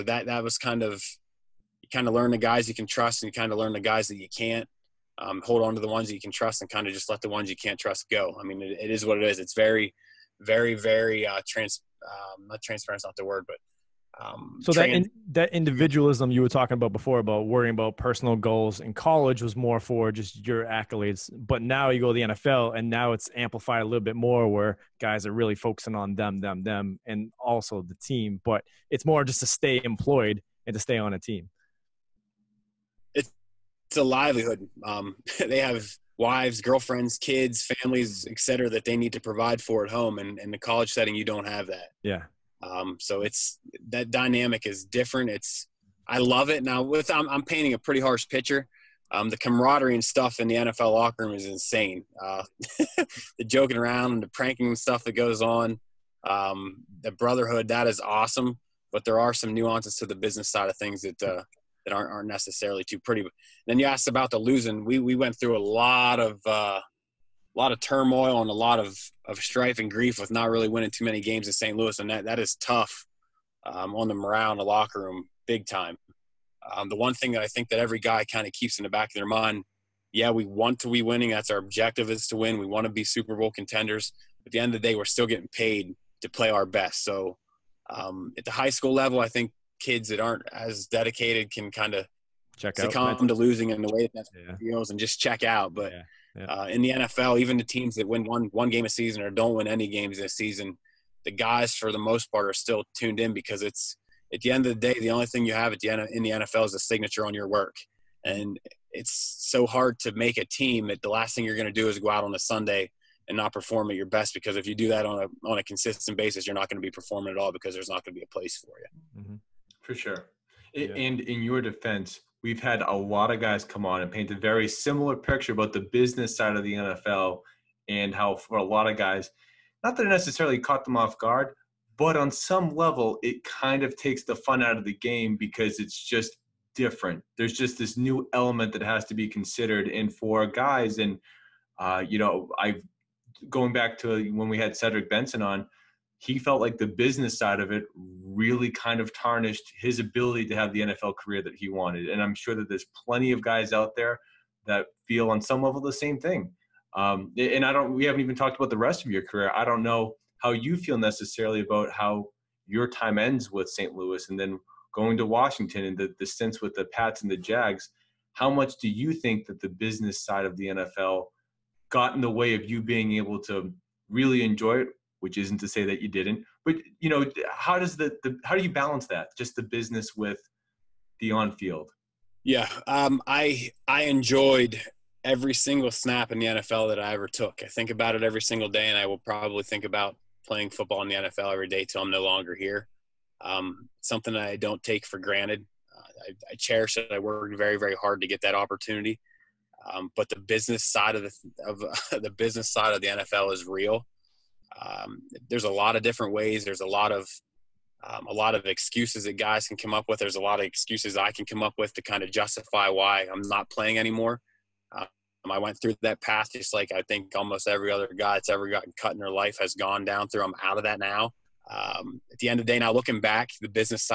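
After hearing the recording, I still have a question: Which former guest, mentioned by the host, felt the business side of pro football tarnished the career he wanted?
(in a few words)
Cedric Benson.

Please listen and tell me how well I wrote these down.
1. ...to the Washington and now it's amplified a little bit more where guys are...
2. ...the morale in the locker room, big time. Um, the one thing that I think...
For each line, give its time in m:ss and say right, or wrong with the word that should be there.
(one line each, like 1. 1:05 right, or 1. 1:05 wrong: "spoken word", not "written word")
1. 0:22 wrong: "NFL", not "Washington"
2. 1:14 right.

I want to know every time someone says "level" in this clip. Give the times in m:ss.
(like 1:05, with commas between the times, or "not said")
1:28, 2:12, 2:35.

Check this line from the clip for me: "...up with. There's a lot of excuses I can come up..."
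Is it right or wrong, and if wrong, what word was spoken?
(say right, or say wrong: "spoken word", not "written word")
right.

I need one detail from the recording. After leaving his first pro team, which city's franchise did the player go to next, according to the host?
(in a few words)
Washington.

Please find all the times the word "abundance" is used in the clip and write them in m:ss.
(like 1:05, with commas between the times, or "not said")
not said.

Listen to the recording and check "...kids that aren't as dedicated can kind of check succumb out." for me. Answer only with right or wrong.
right.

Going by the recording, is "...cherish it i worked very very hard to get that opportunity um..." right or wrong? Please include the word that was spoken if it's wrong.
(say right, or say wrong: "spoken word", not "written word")
right.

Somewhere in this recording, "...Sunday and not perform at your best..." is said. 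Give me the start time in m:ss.
1:52.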